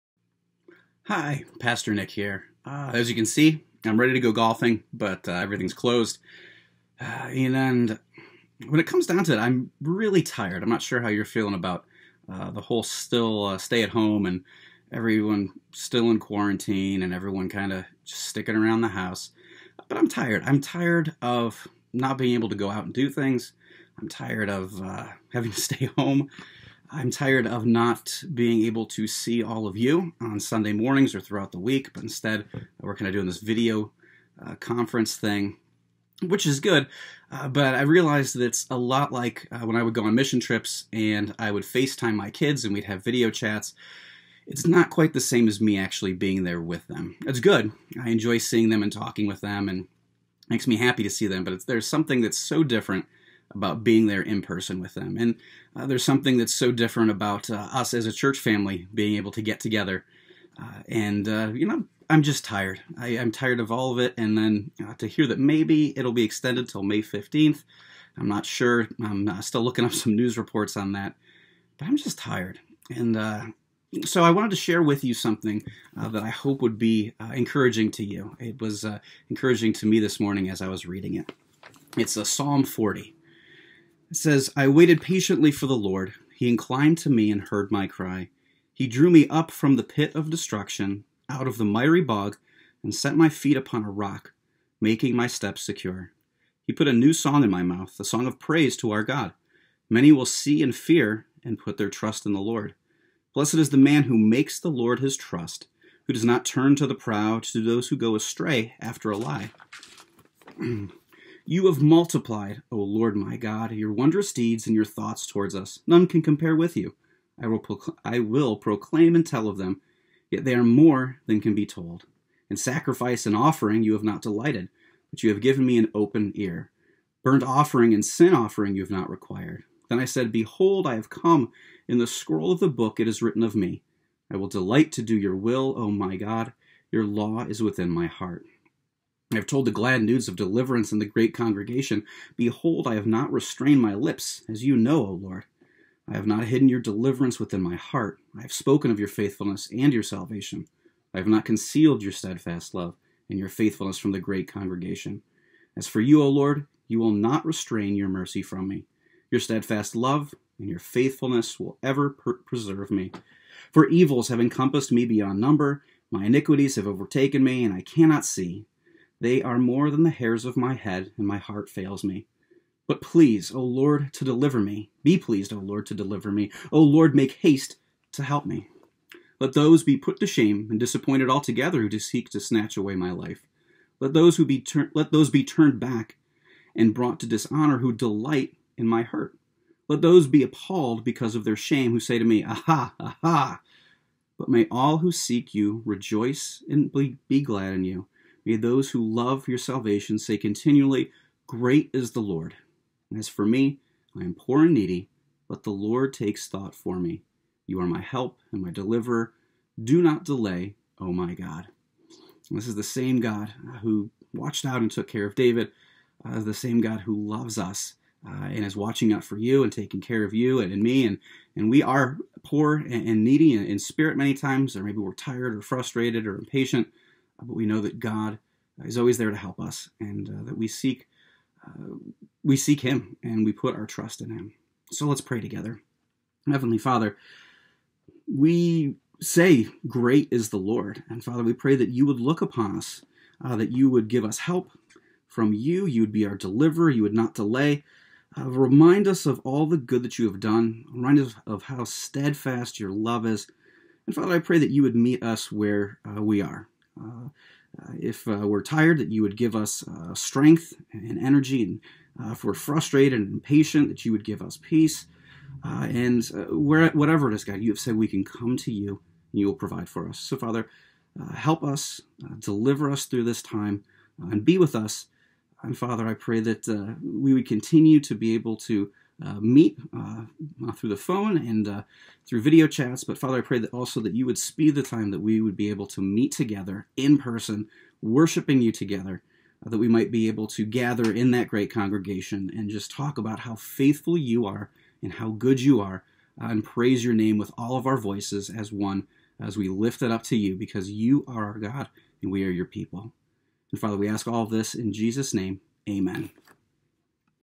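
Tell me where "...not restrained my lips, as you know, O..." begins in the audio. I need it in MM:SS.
02:23.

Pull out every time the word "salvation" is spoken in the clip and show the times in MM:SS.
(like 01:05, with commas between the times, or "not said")
02:30, 03:19.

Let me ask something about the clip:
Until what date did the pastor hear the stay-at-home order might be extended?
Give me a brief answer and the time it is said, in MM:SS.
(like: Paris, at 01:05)
May 15th, at 01:06.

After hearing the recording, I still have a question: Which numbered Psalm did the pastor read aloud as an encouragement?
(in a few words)
Psalm 40.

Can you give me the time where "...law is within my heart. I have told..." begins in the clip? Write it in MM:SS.
02:17.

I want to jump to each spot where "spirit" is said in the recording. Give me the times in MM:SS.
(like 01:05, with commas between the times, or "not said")
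03:43.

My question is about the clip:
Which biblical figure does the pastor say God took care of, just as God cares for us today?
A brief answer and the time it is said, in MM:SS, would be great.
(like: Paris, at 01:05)
David, at 03:35.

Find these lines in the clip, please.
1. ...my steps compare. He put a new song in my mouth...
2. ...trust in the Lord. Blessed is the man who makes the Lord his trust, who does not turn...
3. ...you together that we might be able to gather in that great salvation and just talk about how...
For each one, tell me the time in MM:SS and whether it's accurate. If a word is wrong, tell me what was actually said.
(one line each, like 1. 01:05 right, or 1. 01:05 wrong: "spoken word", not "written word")
1. 01:35 wrong: "secure", not "compare"
2. 01:41 right
3. 04:48 wrong: "congregation", not "salvation".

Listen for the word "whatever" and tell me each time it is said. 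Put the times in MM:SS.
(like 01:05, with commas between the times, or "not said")
04:26.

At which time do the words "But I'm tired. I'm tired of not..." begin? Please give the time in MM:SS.
00:19.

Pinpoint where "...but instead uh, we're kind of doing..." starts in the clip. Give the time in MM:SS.
00:31.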